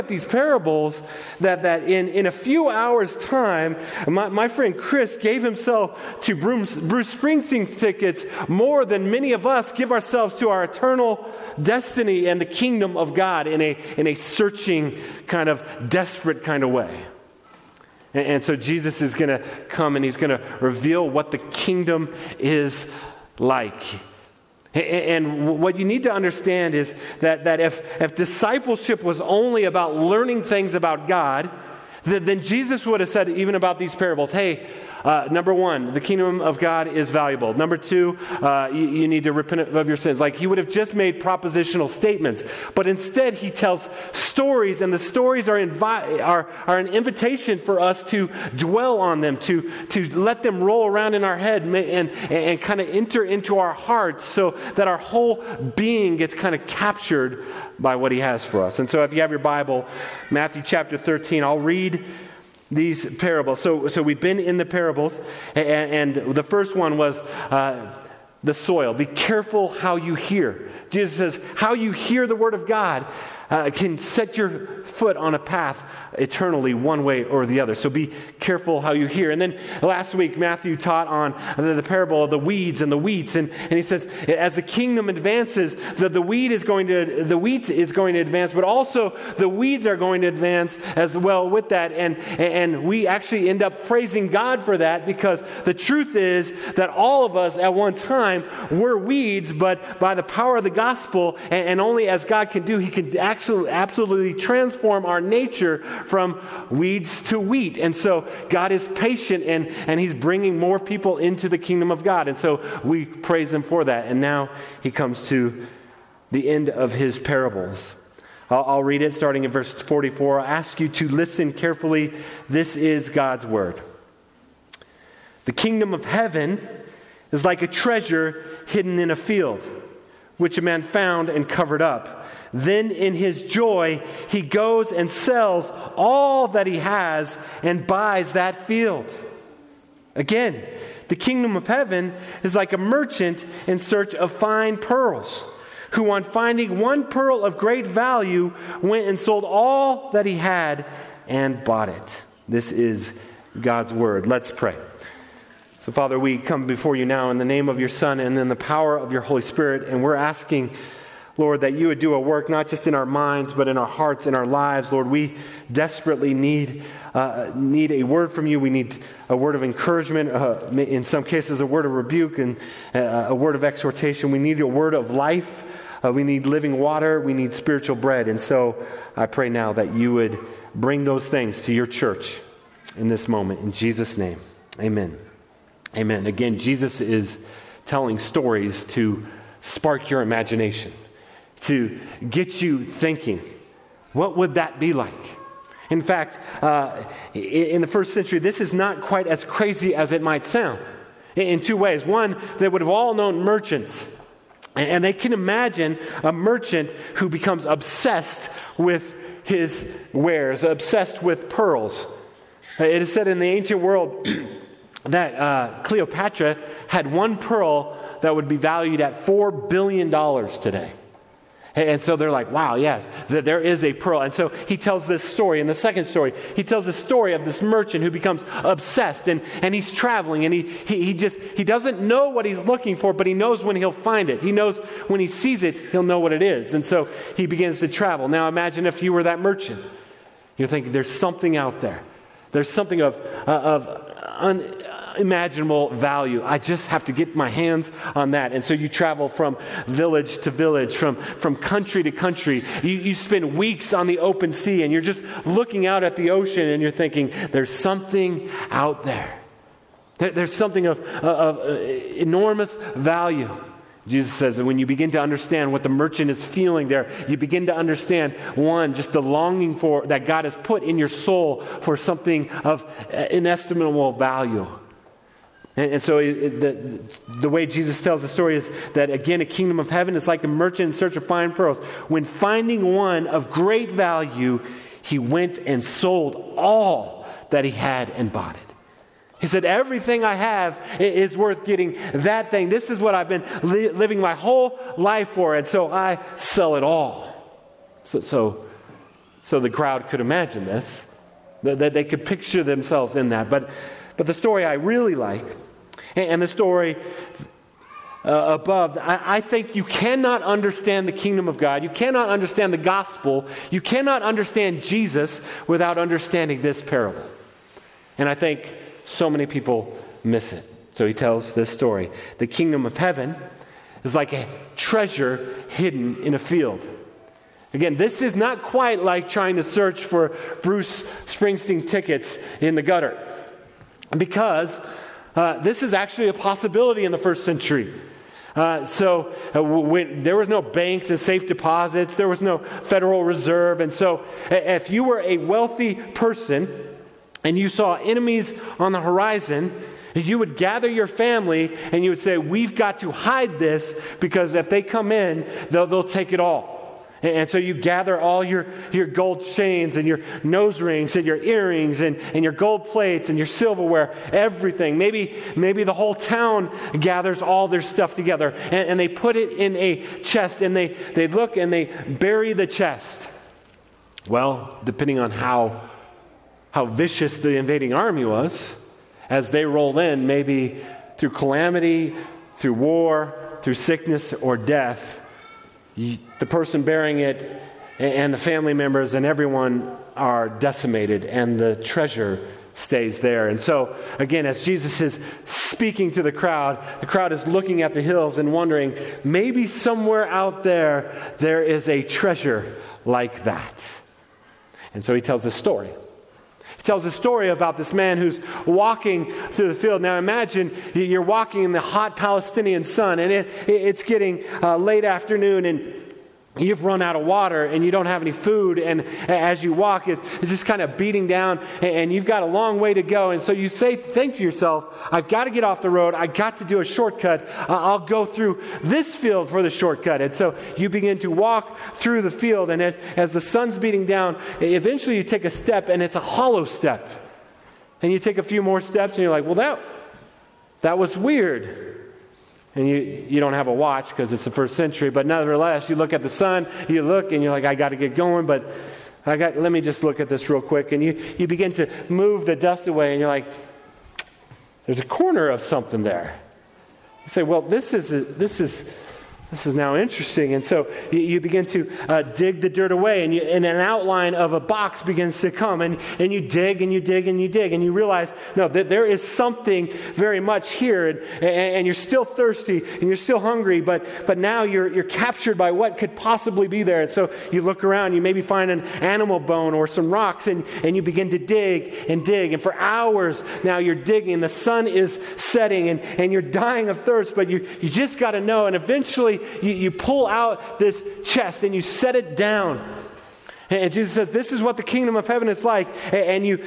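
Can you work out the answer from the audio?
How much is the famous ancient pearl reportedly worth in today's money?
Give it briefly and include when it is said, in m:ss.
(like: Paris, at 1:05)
$4 billion, at 3:39.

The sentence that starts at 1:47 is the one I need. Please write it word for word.
And so God is patient and, and He's bringing more people into the kingdom of God.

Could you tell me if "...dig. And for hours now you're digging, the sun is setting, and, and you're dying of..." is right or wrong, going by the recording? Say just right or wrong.
right.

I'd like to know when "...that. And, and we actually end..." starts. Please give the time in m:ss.
1:31.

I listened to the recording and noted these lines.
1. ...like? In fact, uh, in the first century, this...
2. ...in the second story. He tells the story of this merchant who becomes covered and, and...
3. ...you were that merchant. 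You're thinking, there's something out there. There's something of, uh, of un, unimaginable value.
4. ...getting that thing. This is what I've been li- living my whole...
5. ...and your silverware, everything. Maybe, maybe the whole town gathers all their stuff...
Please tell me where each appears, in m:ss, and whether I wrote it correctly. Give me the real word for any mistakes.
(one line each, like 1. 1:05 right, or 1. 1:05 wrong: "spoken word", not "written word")
1. 3:14 right
2. 3:45 wrong: "obsessed", not "covered"
3. 3:59 right
4. 4:51 right
5. 6:03 right.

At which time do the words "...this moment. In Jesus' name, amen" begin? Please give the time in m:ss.
3:03.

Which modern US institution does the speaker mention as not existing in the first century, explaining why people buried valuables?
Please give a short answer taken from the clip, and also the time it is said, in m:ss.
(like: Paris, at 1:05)
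Federal Reserve, at 5:42.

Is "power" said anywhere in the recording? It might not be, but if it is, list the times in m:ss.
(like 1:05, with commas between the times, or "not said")
1:40, 2:38.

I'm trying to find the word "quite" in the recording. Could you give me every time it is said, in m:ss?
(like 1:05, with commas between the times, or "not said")
3:19, 5:28.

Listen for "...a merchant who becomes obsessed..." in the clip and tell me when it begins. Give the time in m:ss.
3:26.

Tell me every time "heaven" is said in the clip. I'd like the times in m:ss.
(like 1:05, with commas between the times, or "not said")
2:06, 2:21, 4:39, 5:22, 8:15.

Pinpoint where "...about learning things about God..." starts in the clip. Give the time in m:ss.
0:29.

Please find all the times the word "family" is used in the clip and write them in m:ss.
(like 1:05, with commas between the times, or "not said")
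5:51, 6:28.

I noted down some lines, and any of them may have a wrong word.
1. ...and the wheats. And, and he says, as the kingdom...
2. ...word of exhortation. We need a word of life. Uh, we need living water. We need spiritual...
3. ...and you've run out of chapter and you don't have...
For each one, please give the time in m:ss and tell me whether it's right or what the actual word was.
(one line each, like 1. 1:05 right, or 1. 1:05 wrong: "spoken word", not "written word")
1. 1:22 right
2. 2:53 right
3. 6:55 wrong: "water", not "chapter".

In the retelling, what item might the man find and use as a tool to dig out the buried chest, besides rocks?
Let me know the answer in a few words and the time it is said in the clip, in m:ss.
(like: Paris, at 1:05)
An animal bone, at 7:58.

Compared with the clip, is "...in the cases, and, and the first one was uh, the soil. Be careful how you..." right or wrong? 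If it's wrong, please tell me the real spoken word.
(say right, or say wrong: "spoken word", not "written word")
wrong: "parables", not "cases".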